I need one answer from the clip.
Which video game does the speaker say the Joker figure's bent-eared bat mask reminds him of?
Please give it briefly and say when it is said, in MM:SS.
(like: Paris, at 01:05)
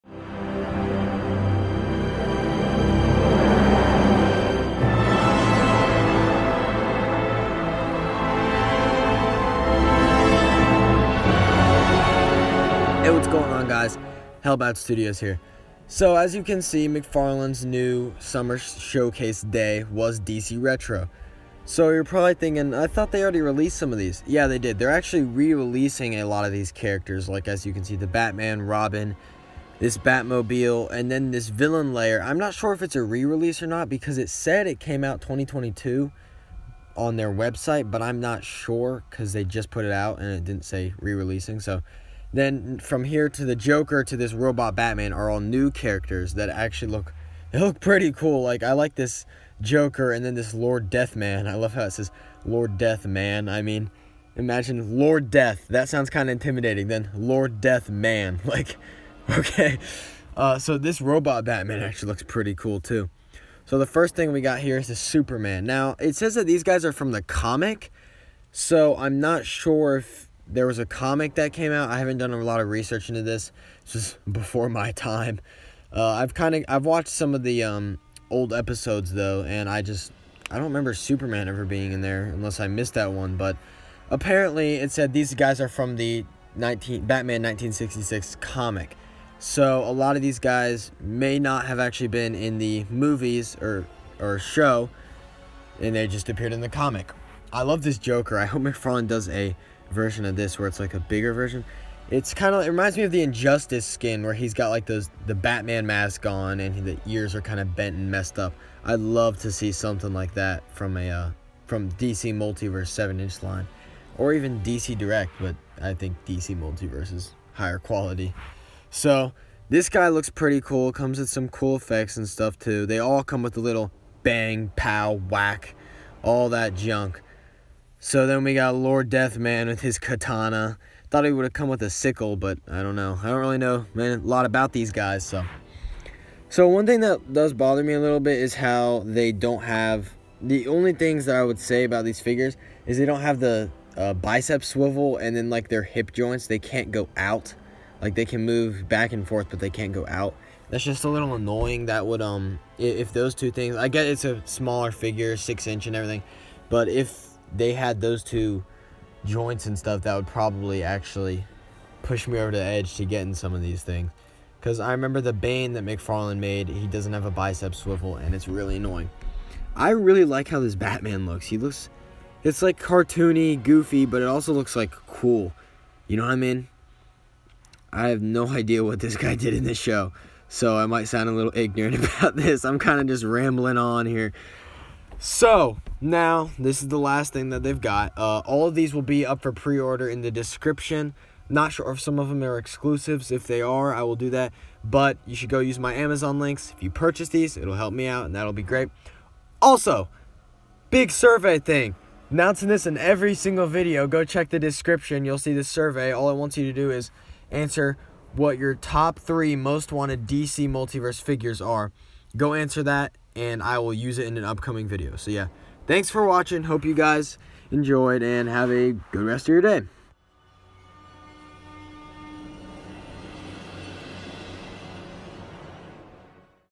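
Injustice, at 01:43.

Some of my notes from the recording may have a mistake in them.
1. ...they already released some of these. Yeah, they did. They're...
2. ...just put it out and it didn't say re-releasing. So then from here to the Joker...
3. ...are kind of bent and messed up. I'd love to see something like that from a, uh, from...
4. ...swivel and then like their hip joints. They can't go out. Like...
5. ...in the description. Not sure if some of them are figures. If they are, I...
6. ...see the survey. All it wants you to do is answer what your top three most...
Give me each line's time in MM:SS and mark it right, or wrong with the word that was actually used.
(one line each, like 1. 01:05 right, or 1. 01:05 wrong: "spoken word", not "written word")
1. 00:23 right
2. 00:39 right
3. 01:47 right
4. 02:24 right
5. 03:10 wrong: "exclusives", not "figures"
6. 03:25 right.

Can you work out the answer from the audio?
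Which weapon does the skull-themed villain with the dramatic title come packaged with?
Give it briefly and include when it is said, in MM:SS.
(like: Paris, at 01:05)
Katana, at 02:09.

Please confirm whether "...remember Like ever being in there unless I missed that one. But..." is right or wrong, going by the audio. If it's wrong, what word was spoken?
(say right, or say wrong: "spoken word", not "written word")
wrong: "Superman", not "Like".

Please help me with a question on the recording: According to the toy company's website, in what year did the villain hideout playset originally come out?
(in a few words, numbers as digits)
2022.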